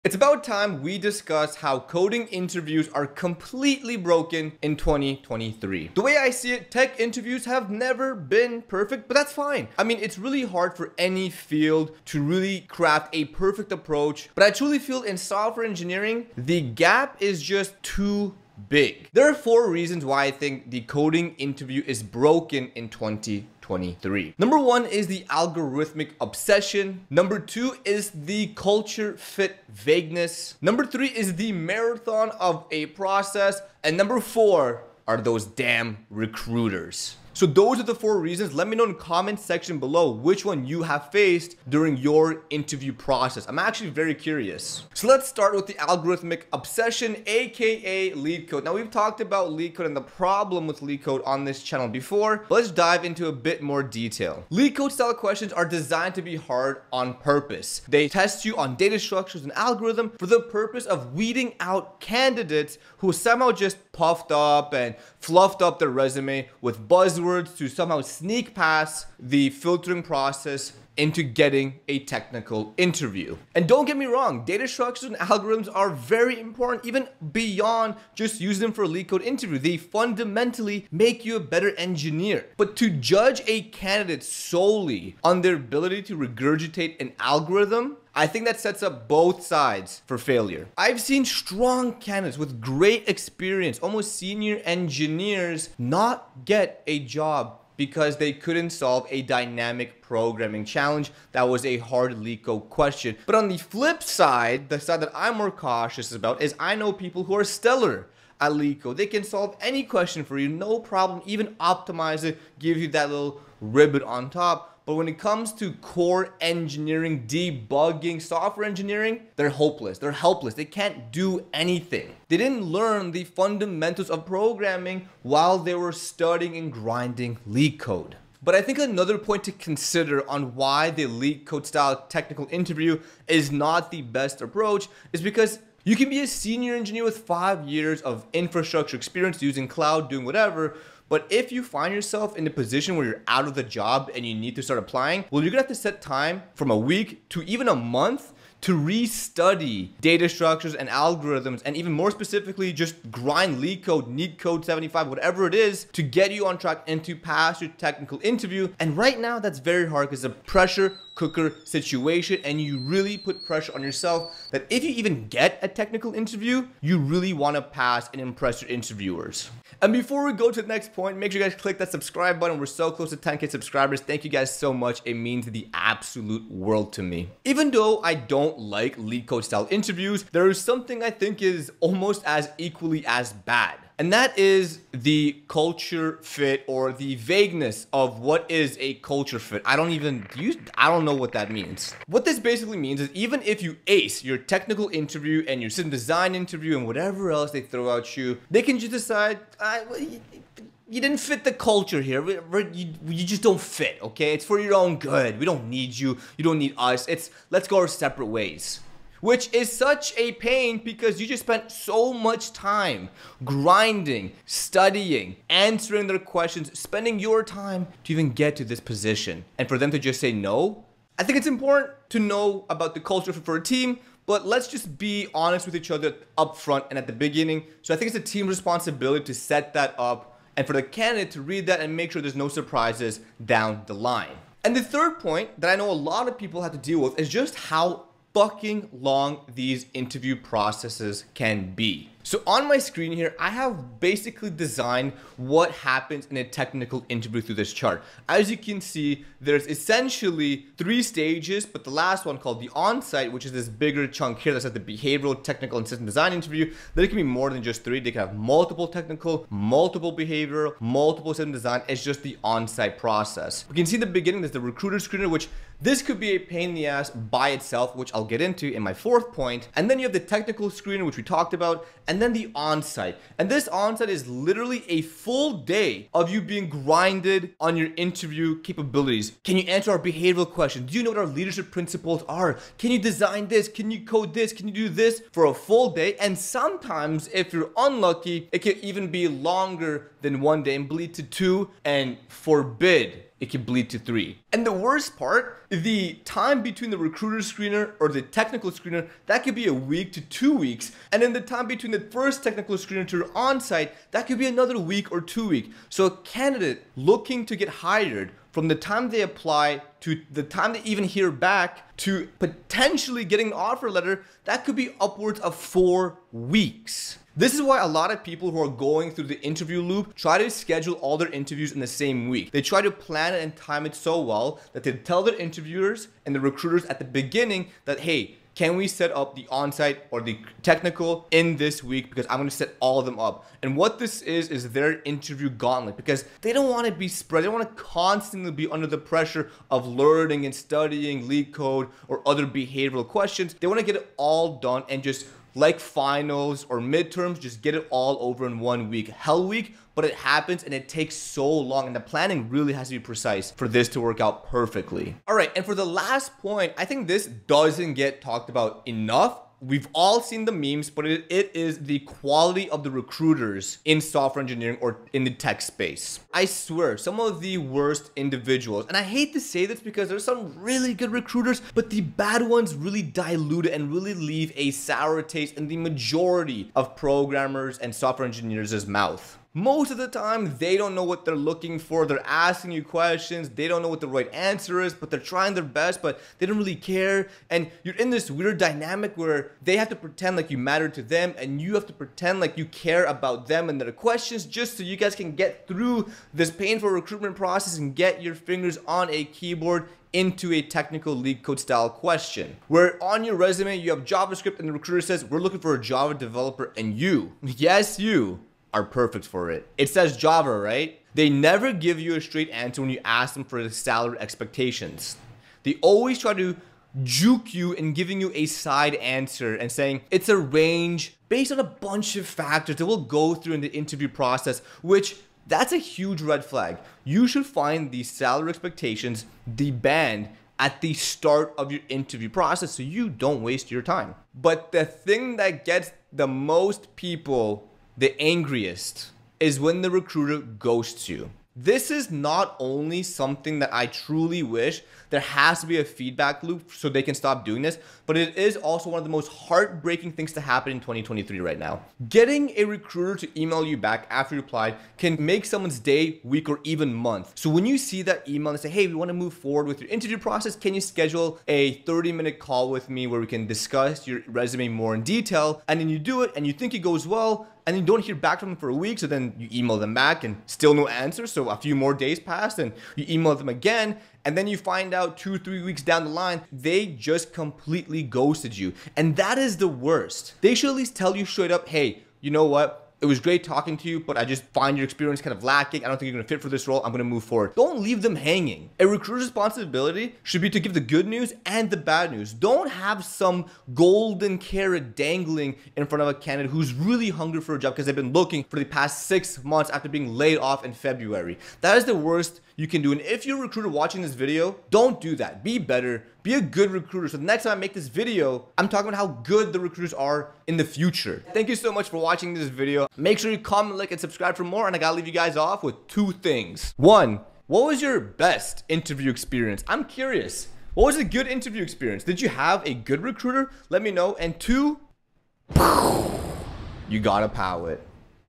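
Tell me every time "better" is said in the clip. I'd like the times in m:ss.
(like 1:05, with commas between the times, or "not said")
1:21, 8:25.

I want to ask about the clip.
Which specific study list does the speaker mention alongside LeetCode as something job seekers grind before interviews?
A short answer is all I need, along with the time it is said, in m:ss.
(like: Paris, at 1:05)
NeetCode 75, at 2:34.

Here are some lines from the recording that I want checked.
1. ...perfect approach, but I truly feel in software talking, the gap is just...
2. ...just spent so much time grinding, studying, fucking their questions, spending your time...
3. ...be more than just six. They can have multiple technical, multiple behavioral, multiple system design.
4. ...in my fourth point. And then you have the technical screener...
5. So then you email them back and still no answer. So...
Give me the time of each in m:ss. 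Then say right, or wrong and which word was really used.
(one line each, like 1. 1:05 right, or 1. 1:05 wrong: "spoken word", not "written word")
1. 0:13 wrong: "engineering", not "talking"
2. 3:31 wrong: "answering", not "fucking"
3. 4:17 wrong: "three", not "six"
4. 4:28 right
5. 7:48 right.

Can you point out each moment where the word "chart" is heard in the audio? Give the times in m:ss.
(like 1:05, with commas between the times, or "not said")
4:07.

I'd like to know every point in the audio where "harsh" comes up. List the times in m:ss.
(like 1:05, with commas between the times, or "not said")
not said.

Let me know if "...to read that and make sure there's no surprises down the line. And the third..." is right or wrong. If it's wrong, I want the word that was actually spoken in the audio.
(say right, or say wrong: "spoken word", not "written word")
right.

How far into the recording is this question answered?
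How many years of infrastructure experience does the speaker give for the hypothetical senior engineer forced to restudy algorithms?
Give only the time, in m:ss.
2:17.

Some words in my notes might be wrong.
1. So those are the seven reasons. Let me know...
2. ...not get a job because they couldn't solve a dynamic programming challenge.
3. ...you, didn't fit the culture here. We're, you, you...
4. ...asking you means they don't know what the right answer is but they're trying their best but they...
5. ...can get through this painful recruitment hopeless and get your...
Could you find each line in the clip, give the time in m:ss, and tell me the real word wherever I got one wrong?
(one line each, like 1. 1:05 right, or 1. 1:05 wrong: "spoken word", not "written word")
1. 0:37 wrong: "four", not "seven"
2. 1:35 right
3. 3:20 right
4. 6:22 wrong: "questions", not "means"
5. 6:35 wrong: "process", not "hopeless".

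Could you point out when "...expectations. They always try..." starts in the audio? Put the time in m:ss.
6:54.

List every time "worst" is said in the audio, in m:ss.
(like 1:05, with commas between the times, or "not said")
4:54, 6:07, 7:59, 8:21.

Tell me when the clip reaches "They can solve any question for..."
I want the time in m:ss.
1:48.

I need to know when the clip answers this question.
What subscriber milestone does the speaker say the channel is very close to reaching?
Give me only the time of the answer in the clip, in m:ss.
2:53.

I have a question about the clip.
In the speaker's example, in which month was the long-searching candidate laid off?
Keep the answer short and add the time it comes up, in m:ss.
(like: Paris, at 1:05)
February, at 8:20.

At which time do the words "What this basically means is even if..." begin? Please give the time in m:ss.
3:12.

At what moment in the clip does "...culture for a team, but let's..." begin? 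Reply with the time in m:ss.
3:42.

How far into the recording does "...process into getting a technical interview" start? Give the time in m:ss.
1:10.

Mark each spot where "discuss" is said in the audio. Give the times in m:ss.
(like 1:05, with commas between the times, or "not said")
0:00, 7:43.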